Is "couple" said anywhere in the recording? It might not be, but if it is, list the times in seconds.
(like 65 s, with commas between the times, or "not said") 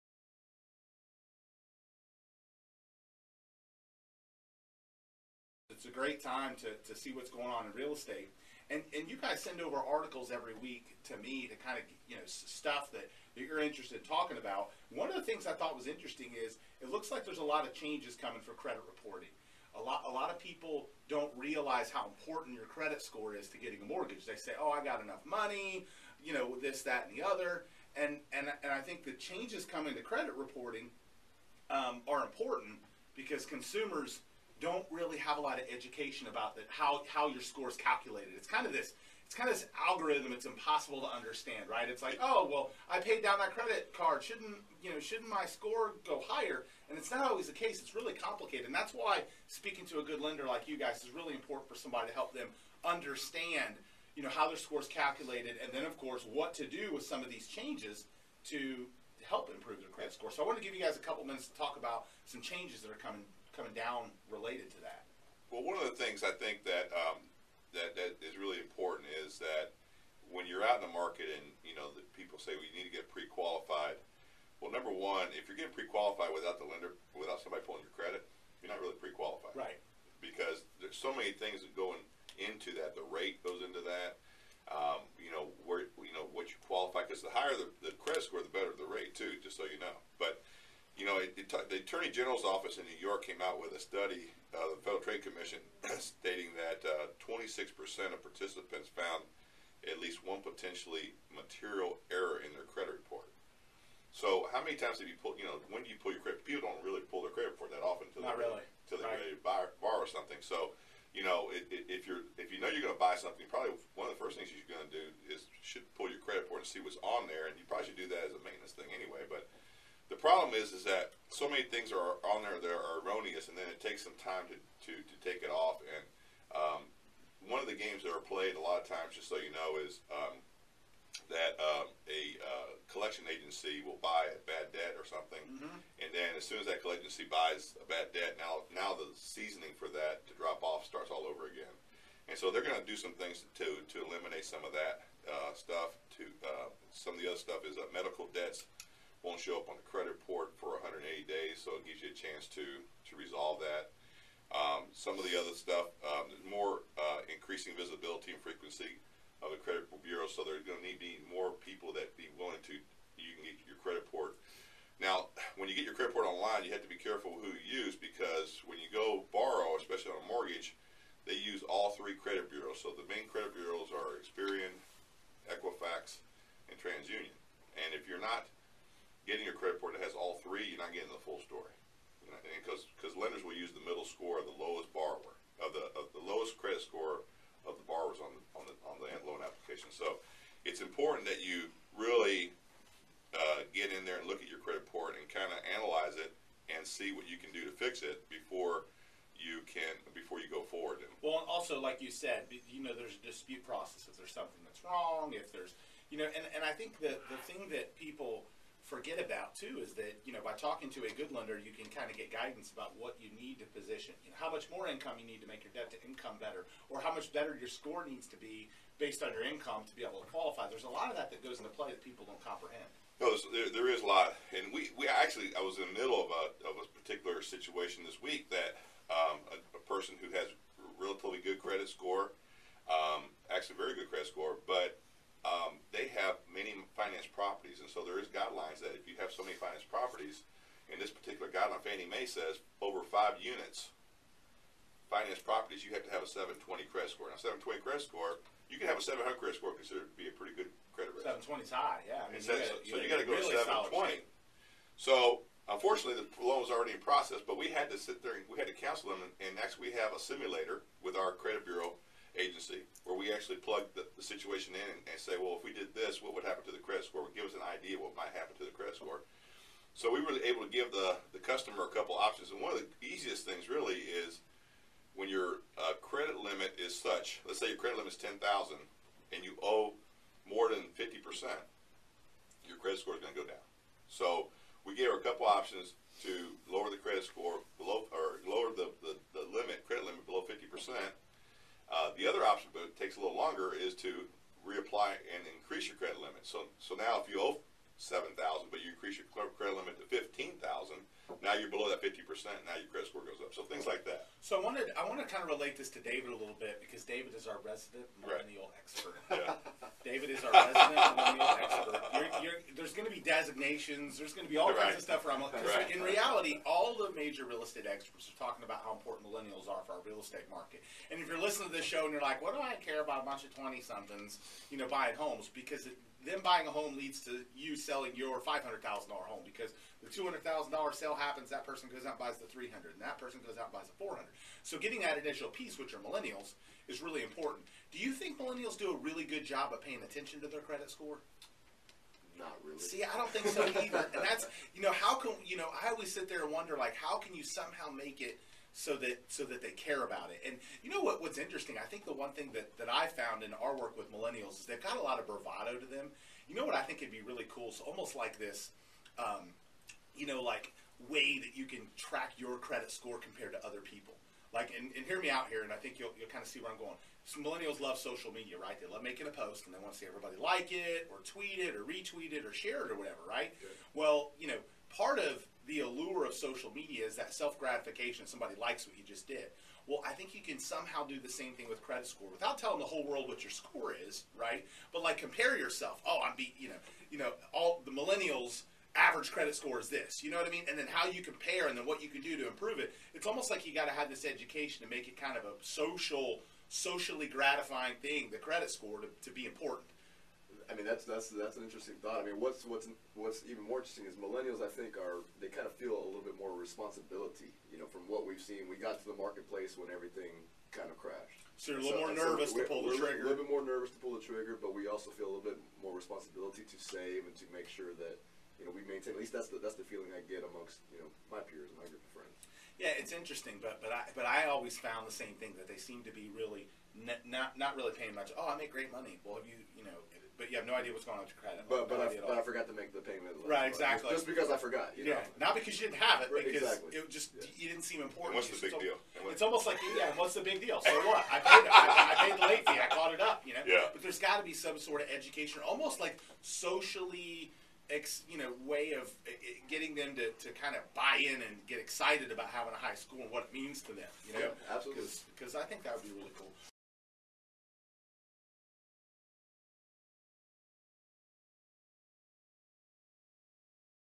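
60 s, 271 s, 285 s.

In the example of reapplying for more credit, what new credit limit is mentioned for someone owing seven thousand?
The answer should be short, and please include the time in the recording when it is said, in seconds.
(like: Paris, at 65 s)
$15,000, at 300 s.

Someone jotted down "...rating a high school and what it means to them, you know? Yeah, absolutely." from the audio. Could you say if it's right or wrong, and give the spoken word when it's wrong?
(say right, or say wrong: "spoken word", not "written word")
wrong: "having", not "rating".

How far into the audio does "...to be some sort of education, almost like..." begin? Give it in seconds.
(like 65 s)
444 s.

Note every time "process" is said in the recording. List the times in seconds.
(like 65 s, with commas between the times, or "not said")
203 s, 257 s.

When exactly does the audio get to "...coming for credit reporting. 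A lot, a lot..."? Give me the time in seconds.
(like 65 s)
18 s.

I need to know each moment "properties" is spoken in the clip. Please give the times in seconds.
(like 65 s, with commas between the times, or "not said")
239 s, 245 s.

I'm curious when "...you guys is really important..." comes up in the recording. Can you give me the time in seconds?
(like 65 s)
50 s.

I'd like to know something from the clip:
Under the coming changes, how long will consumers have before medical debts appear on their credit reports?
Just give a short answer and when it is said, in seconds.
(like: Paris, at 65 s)
180 days, at 150 s.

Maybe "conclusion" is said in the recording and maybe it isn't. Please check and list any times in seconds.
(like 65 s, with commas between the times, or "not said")
not said.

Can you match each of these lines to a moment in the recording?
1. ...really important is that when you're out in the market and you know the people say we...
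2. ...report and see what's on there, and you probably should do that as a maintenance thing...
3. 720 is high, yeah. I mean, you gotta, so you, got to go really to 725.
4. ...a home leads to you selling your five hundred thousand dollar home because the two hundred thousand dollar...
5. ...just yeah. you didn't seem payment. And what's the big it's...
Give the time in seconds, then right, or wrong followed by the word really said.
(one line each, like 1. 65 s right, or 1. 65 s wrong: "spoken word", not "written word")
1. 68 s right
2. 116 s right
3. 251 s wrong: "720", not "725"
4. 326 s right
5. 437 s wrong: "important", not "payment".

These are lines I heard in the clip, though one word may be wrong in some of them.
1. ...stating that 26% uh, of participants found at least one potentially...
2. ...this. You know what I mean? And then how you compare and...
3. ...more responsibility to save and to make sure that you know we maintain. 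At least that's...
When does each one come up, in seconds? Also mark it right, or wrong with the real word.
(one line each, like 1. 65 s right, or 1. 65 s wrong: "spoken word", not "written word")
1. 95 s right
2. 389 s right
3. 415 s right.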